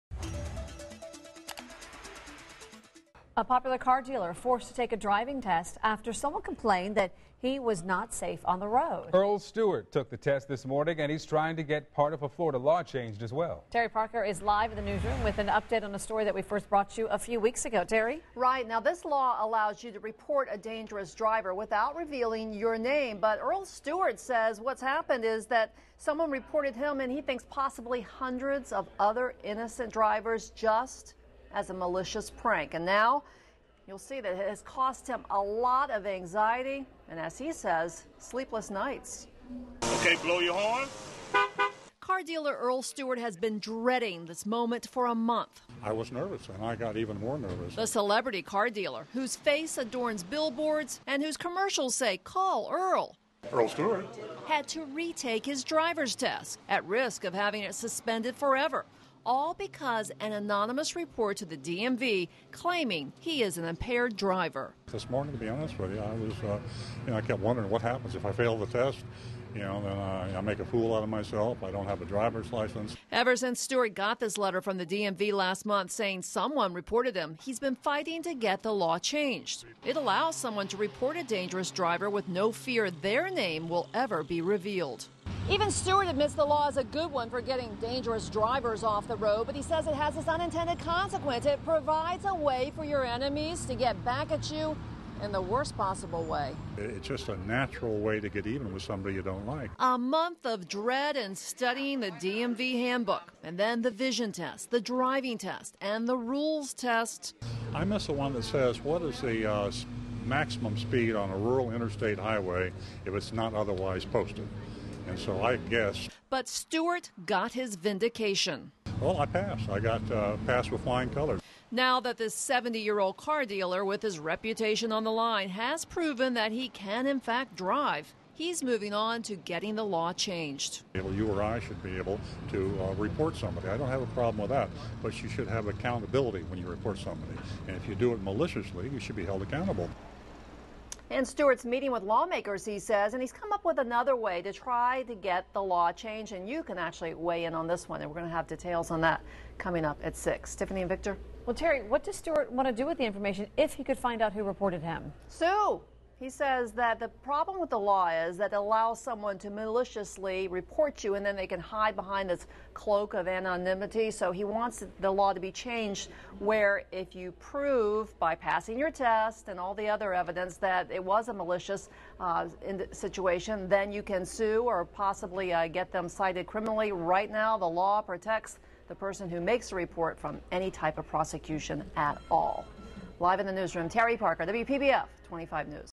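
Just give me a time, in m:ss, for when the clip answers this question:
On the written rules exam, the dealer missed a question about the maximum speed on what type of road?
1:51.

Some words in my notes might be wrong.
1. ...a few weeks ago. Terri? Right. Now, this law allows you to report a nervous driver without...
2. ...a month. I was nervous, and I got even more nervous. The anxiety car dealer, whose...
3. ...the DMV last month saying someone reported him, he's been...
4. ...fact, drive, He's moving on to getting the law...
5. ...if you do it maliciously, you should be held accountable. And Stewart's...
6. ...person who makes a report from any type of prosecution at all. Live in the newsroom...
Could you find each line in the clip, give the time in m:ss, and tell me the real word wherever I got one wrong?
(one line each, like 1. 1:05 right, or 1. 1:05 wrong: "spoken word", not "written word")
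1. 0:17 wrong: "dangerous", not "nervous"
2. 0:45 wrong: "celebrity", not "anxiety"
3. 1:14 right
4. 2:07 right
5. 2:17 right
6. 2:58 right.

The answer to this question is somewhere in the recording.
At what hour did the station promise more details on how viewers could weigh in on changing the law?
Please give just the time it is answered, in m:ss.
2:30.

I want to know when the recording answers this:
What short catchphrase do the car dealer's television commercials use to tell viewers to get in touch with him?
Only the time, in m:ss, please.
0:52.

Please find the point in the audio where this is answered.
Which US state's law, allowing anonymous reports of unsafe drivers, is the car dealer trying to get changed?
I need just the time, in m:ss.
0:12.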